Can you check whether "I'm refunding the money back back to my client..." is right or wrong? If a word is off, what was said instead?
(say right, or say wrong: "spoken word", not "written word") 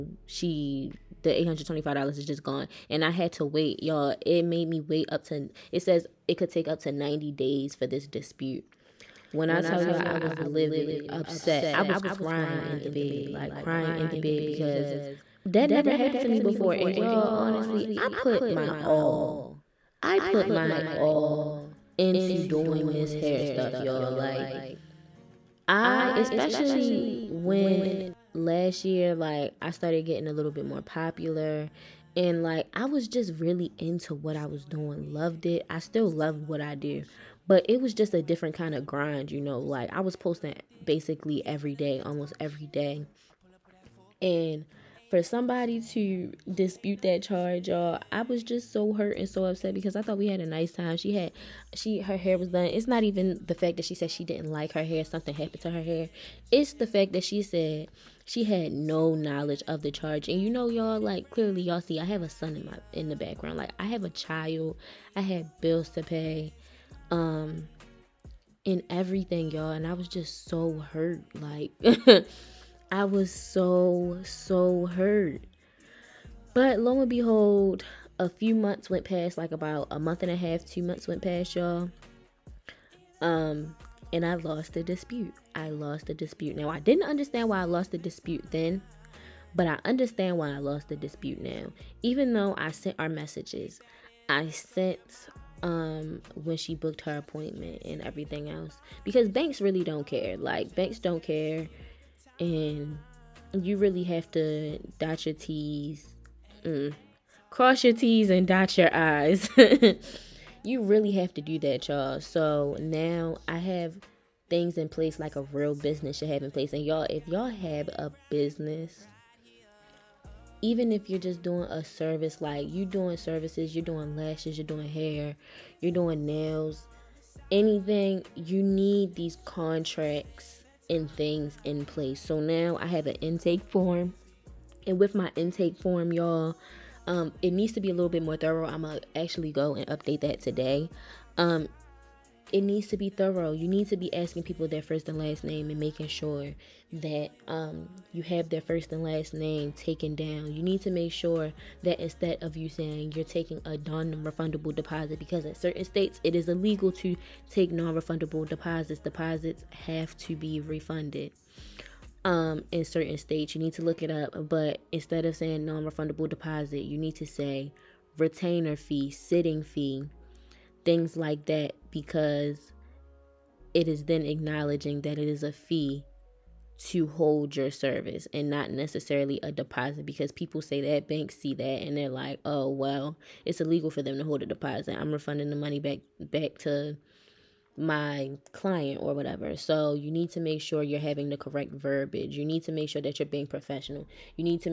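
right.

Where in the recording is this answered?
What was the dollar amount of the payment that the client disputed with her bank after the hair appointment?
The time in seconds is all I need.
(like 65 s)
1 s.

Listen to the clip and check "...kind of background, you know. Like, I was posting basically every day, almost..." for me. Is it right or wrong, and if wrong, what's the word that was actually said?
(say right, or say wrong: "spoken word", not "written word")
wrong: "grind", not "background".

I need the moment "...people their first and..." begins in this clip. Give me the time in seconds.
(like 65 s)
144 s.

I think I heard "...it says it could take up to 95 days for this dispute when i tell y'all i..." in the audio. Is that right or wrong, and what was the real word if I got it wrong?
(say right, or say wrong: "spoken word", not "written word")
wrong: "90", not "95".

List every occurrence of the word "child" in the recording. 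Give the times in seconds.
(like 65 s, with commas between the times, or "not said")
64 s.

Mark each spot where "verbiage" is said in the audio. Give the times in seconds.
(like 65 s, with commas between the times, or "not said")
191 s.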